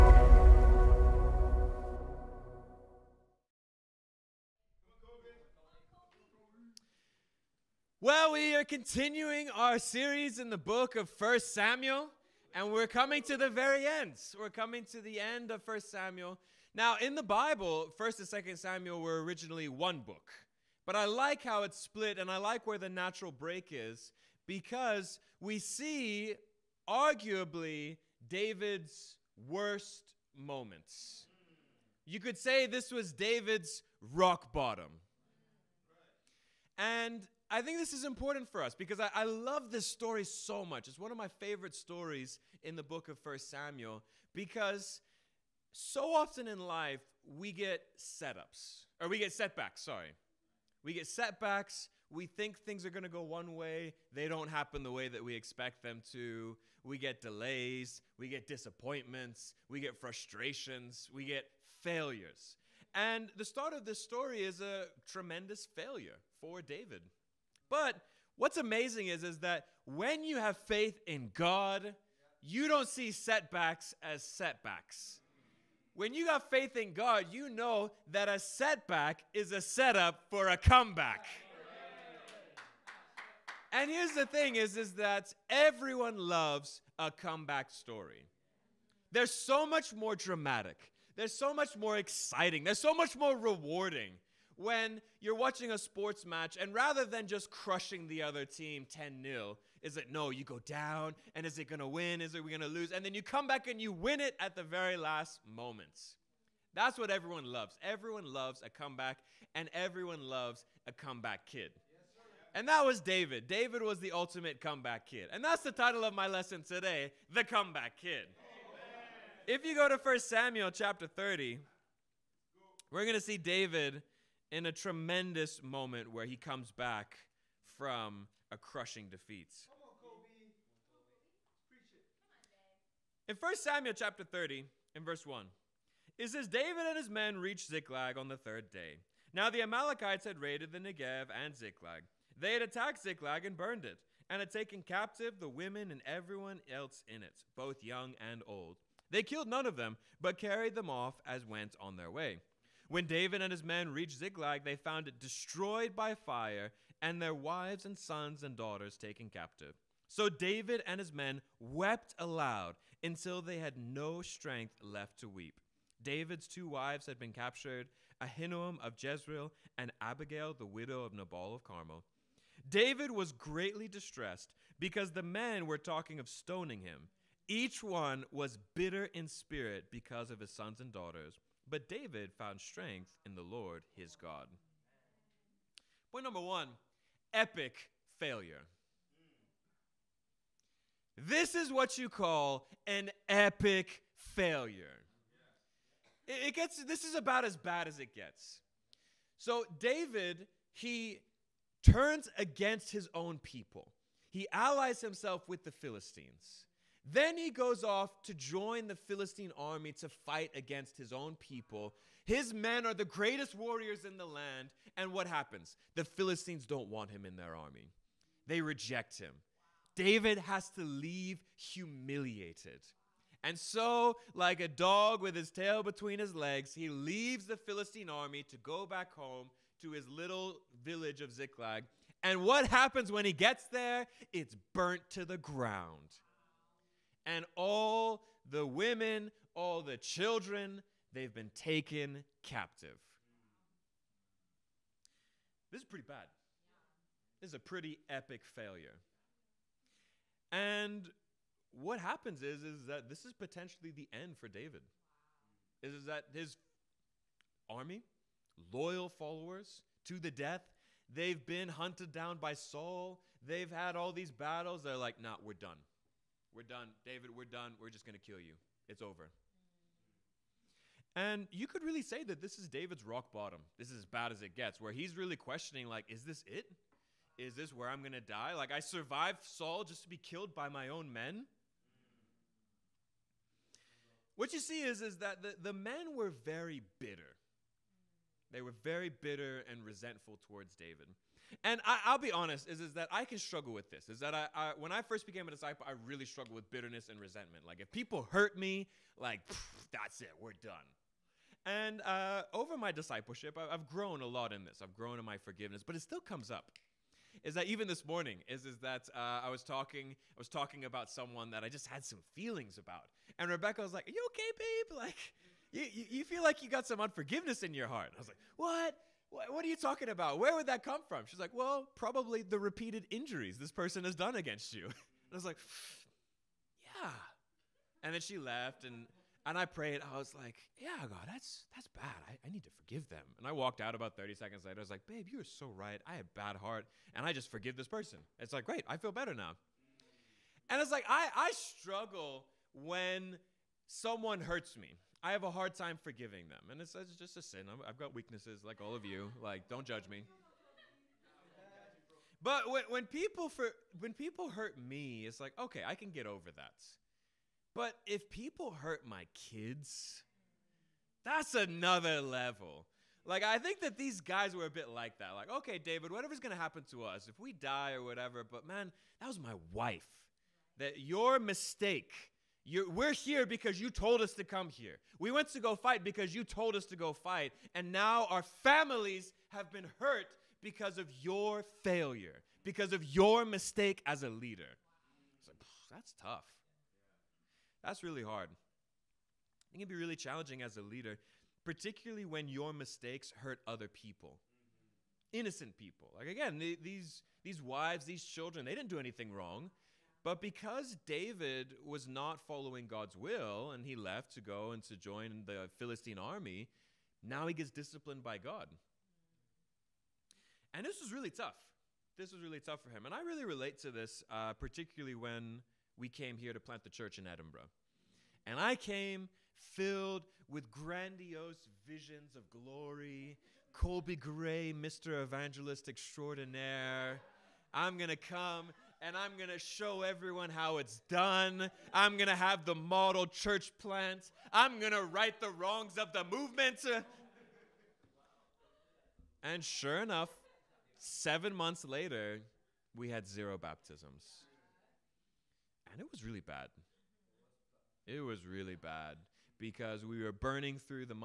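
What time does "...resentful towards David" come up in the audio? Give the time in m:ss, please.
4:49.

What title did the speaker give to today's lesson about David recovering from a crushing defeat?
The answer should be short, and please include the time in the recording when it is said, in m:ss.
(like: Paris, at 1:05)
The Comeback Kid, at 1:57.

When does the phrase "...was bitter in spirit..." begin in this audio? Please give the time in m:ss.
2:58.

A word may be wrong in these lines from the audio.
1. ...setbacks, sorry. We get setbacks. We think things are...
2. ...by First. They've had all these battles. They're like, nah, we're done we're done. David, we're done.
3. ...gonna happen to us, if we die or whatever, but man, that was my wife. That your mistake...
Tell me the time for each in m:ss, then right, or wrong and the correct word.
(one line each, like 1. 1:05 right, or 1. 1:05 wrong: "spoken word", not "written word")
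1. 0:49 right
2. 4:22 wrong: "Saul", not "First"
3. 6:06 right.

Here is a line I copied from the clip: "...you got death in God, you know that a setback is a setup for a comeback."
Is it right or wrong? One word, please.
wrong.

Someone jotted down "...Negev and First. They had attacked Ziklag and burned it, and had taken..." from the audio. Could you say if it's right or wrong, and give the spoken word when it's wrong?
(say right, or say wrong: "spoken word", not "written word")
wrong: "Ziklag", not "First".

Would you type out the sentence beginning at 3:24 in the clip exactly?
He allies himself with the Philistines.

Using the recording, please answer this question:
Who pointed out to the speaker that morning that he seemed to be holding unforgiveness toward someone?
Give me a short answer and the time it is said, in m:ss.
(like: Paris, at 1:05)
Rebecca, at 5:13.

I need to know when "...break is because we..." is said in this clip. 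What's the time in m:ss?
0:23.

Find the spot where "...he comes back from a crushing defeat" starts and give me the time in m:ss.
2:06.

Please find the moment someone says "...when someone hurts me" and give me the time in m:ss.
5:42.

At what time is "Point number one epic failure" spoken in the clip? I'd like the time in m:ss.
3:06.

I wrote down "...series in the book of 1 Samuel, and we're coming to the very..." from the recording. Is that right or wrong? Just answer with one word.
right.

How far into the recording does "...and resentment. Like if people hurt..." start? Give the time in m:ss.
4:57.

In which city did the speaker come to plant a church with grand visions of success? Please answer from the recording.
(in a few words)
Edinburgh.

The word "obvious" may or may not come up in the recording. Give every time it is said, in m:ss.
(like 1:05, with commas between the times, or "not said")
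not said.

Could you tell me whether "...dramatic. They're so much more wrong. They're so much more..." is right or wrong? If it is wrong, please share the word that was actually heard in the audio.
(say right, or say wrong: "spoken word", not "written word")
wrong: "exciting", not "wrong".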